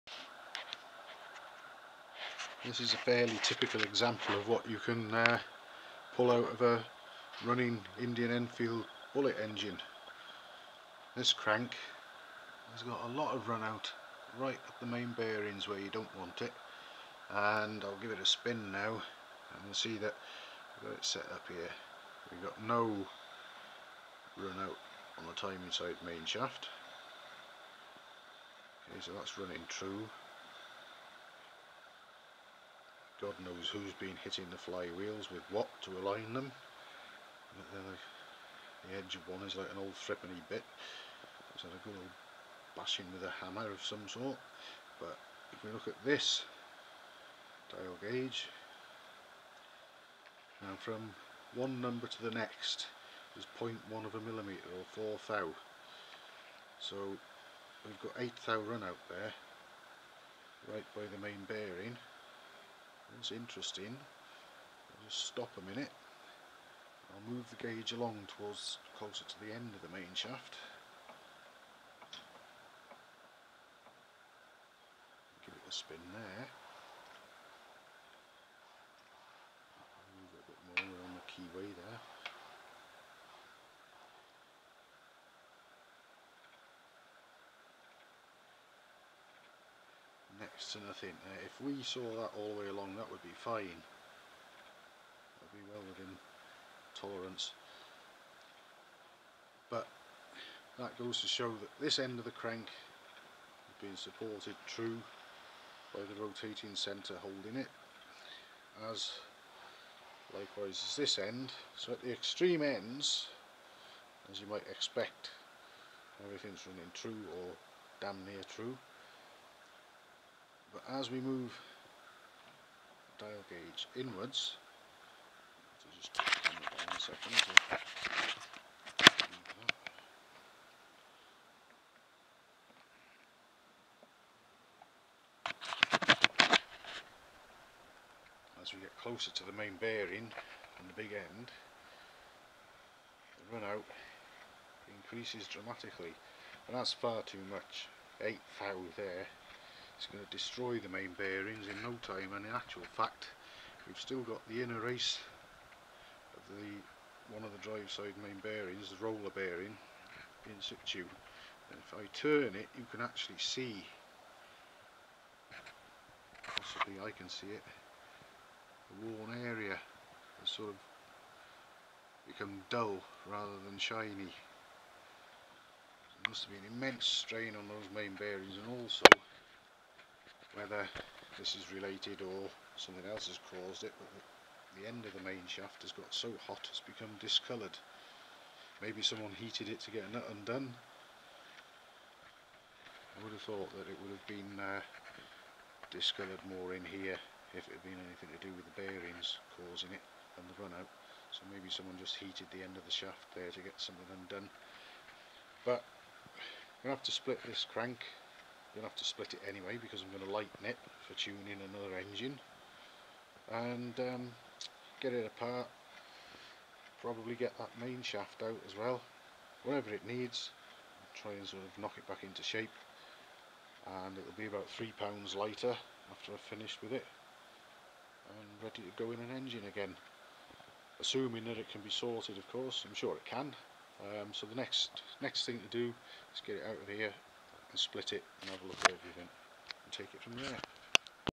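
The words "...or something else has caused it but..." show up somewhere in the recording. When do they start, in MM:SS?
03:02.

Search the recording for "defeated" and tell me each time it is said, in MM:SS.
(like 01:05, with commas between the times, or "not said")
not said.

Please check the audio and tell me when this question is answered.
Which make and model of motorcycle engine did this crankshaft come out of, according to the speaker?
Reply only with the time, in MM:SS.
00:07.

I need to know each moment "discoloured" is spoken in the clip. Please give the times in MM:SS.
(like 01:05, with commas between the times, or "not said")
03:07, 03:15.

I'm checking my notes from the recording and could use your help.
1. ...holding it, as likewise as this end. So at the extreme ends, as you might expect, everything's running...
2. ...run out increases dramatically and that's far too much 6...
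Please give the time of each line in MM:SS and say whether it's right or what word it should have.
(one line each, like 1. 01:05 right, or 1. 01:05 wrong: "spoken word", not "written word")
1. 01:47 right
2. 02:23 wrong: "8", not "6".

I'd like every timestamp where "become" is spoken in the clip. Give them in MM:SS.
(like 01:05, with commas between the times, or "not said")
02:52, 03:06.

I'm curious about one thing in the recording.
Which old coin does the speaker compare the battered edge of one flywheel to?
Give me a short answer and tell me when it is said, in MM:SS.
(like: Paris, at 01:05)
threepenny bit, at 00:39.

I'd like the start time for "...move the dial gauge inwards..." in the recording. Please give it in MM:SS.
02:01.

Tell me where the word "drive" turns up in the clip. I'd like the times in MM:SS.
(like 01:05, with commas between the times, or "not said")
02:37.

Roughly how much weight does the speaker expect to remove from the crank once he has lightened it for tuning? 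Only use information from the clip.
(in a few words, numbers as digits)
3 pounds.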